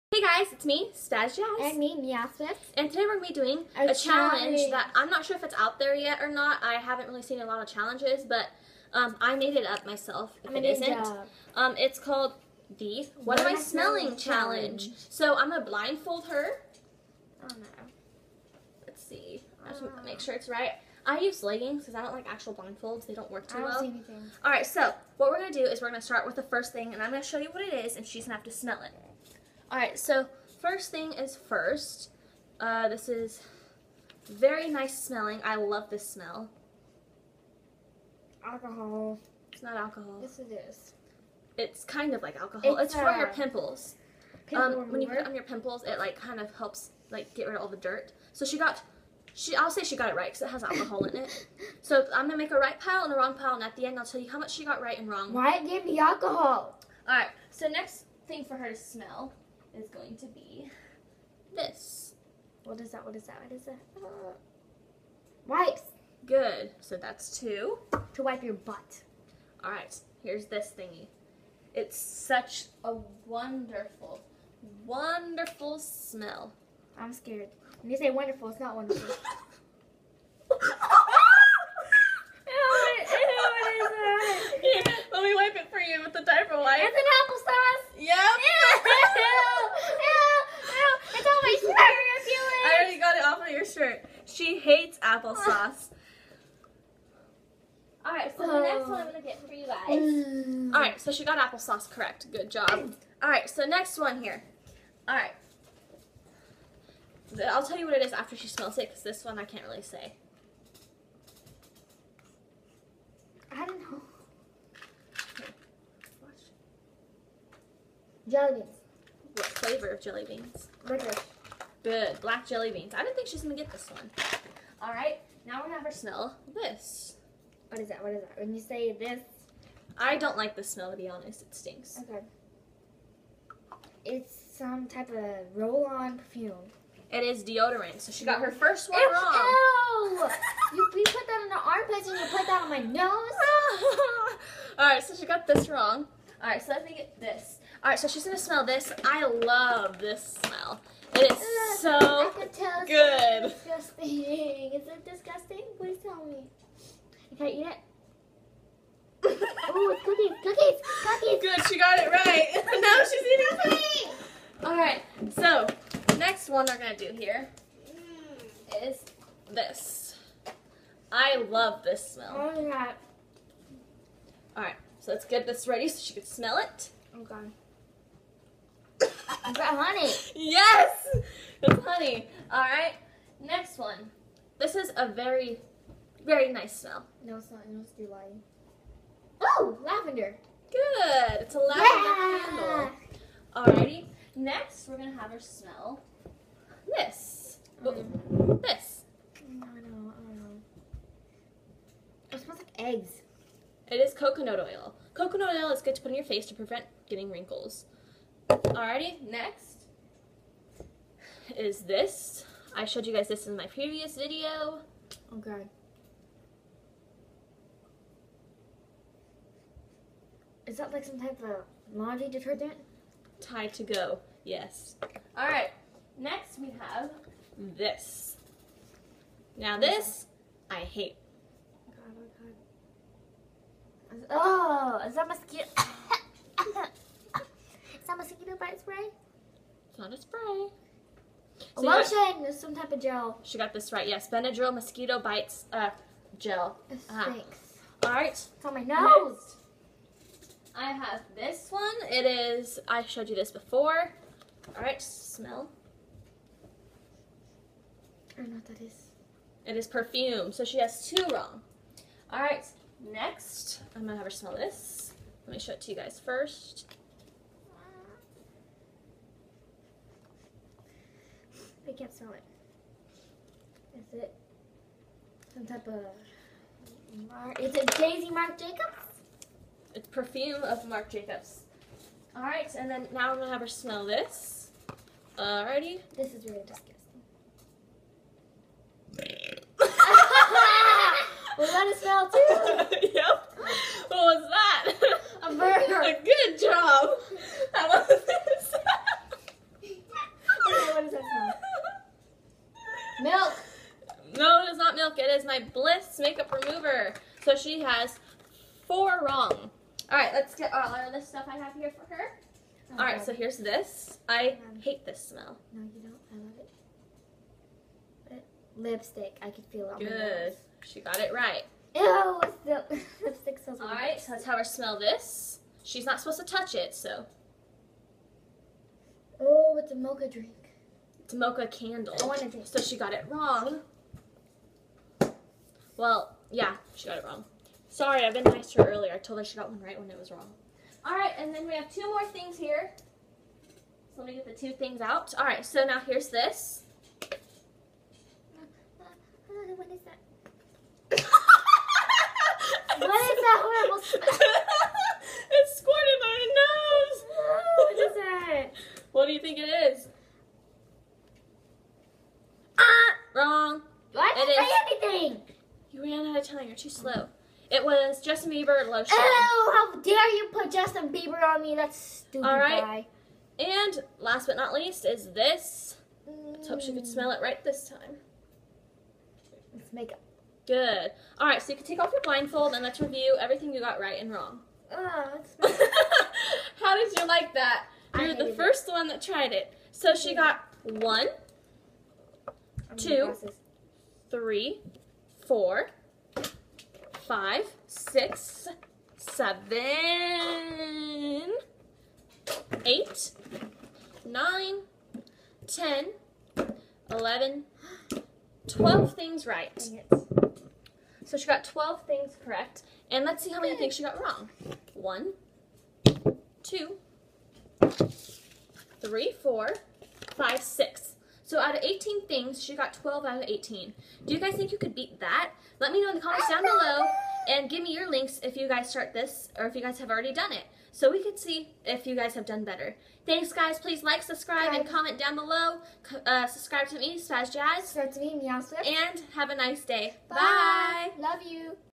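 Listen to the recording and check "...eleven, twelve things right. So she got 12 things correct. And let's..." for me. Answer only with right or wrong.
right.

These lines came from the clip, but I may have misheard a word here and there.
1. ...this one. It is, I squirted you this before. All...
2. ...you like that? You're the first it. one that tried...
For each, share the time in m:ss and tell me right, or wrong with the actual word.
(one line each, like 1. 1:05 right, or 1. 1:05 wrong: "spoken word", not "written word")
1. 4:11 wrong: "showed", not "squirted"
2. 6:27 right.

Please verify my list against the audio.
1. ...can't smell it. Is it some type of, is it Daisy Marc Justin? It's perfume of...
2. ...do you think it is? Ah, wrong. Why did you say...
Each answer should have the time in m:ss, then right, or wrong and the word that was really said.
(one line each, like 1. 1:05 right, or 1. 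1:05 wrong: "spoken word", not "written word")
1. 4:31 wrong: "Jacobs", not "Justin"
2. 5:59 right.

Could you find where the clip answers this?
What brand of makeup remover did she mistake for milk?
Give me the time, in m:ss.
5:05.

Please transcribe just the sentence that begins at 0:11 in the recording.
Um, it's called the What, what Am I, I Smelling, smelling challenge.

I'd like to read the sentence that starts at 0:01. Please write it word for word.
And me, Mia And today we're going to be doing a, a challenge.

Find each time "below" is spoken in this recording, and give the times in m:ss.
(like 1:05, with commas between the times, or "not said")
7:06, 7:15.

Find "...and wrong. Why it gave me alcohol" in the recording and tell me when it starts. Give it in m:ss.
0:54.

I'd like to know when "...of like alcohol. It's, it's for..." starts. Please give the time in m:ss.
0:42.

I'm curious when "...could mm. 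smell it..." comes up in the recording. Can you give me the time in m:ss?
6:16.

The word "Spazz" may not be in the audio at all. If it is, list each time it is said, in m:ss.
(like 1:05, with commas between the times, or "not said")
0:00, 7:17.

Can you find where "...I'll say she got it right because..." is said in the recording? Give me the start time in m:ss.
0:49.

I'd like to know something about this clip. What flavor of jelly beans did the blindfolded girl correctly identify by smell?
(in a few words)
Licorice.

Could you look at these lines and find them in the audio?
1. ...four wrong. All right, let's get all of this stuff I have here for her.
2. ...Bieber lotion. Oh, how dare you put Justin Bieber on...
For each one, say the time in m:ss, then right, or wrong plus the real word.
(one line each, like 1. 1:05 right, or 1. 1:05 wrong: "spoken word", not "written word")
1. 5:08 right
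2. 6:08 right.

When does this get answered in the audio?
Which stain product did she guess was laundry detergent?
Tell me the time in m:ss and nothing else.
3:43.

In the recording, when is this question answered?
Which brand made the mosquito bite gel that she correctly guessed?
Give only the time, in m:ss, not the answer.
4:04.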